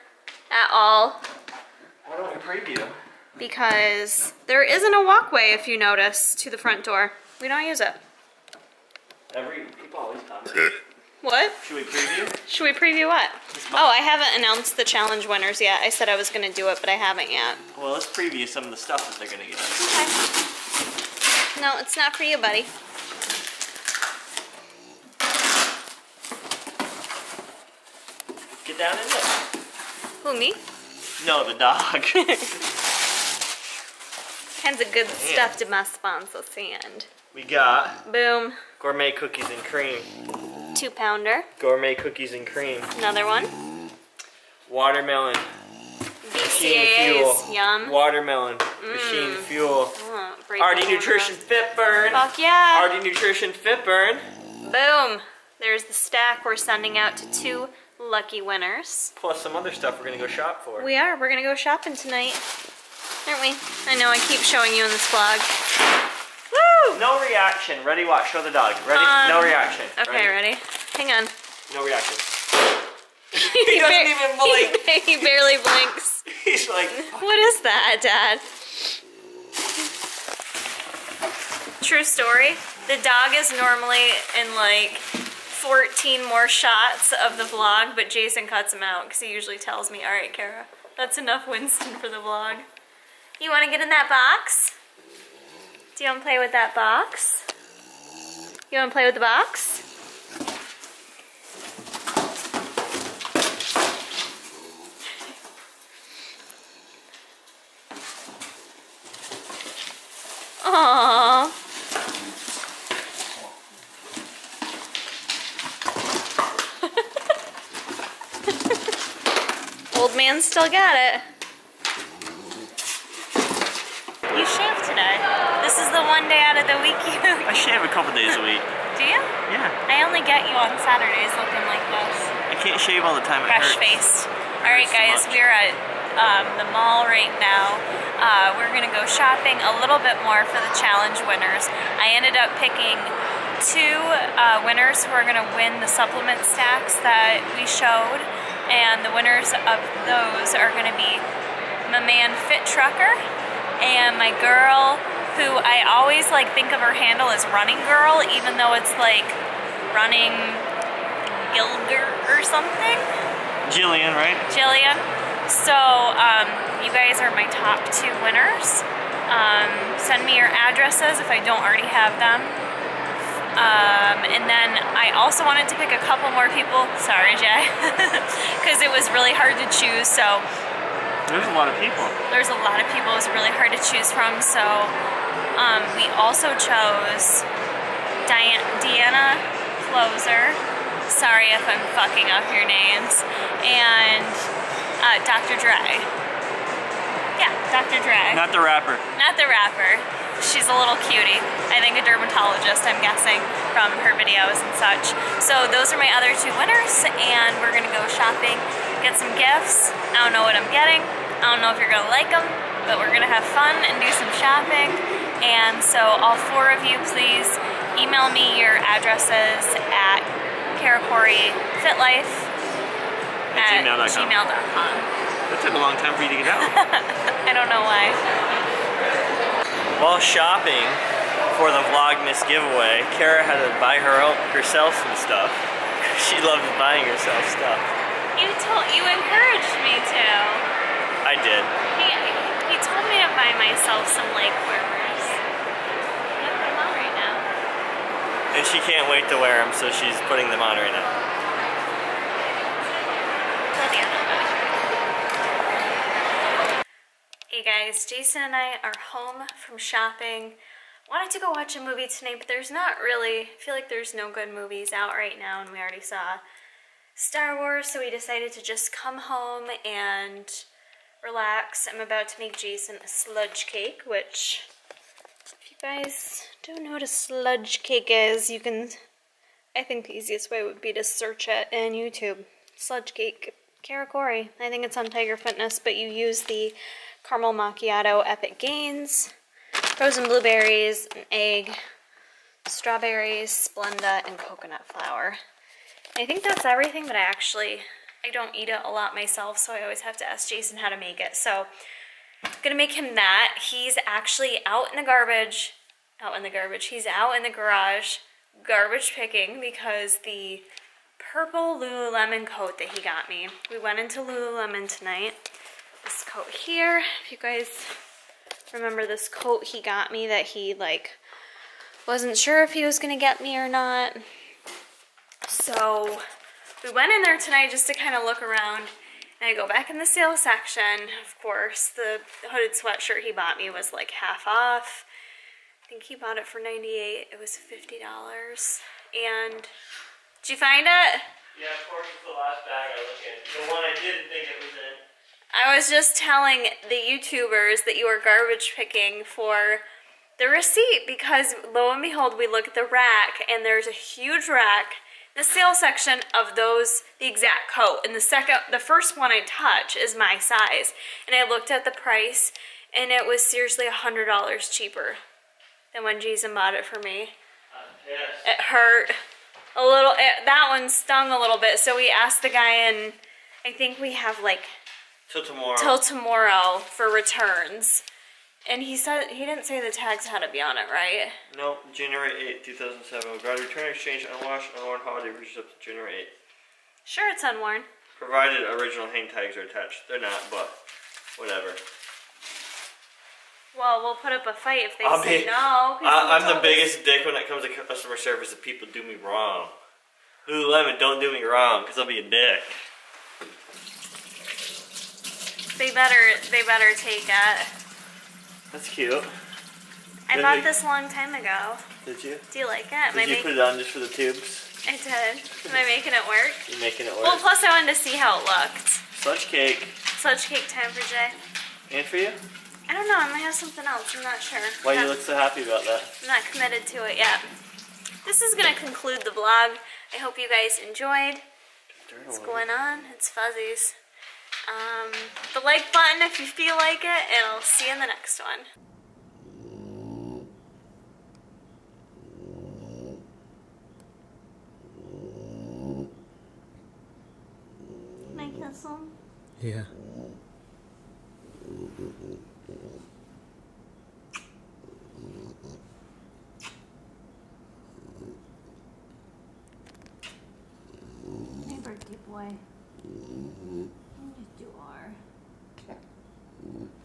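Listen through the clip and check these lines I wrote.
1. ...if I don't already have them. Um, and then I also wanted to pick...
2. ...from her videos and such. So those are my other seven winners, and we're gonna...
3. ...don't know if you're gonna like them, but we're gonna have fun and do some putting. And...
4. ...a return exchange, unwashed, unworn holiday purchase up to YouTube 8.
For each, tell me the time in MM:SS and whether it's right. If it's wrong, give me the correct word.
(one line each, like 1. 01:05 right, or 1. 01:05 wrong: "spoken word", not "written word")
1. 02:51 right
2. 03:23 wrong: "two", not "seven"
3. 03:31 wrong: "shopping", not "putting"
4. 06:23 wrong: "January", not "YouTube".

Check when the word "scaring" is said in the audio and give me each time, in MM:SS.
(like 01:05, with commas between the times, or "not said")
not said.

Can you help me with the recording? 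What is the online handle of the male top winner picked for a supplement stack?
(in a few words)
Fit Trucker.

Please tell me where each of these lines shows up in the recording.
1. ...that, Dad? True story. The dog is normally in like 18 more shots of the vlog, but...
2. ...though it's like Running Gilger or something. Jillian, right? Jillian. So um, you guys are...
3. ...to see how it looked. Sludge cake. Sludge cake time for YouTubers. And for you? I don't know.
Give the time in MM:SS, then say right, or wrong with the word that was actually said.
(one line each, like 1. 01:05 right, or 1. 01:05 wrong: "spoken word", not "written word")
1. 01:17 wrong: "14", not "18"
2. 02:38 right
3. 06:57 wrong: "Jay", not "YouTubers".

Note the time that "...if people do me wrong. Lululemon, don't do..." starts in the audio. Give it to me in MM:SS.
06:38.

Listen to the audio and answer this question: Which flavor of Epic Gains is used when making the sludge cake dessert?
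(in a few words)
Caramel macchiato.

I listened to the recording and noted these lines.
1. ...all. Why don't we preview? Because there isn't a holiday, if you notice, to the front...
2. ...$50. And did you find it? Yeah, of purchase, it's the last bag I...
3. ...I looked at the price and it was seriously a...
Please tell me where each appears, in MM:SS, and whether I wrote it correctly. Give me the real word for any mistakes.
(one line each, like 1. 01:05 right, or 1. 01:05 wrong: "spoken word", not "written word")
1. 00:00 wrong: "walkway", not "holiday"
2. 05:37 wrong: "course", not "purchase"
3. 06:01 right.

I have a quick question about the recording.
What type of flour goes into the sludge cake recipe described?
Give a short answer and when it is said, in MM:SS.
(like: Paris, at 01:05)
Coconut flour, at 04:54.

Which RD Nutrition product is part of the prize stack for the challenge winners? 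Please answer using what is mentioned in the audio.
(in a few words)
Fit Burn.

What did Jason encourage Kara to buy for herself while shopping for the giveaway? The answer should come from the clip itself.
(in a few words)
Leg warmers.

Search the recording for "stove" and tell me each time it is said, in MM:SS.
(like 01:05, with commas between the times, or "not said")
not said.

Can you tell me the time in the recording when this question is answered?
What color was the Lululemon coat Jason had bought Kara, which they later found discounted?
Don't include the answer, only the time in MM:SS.
05:11.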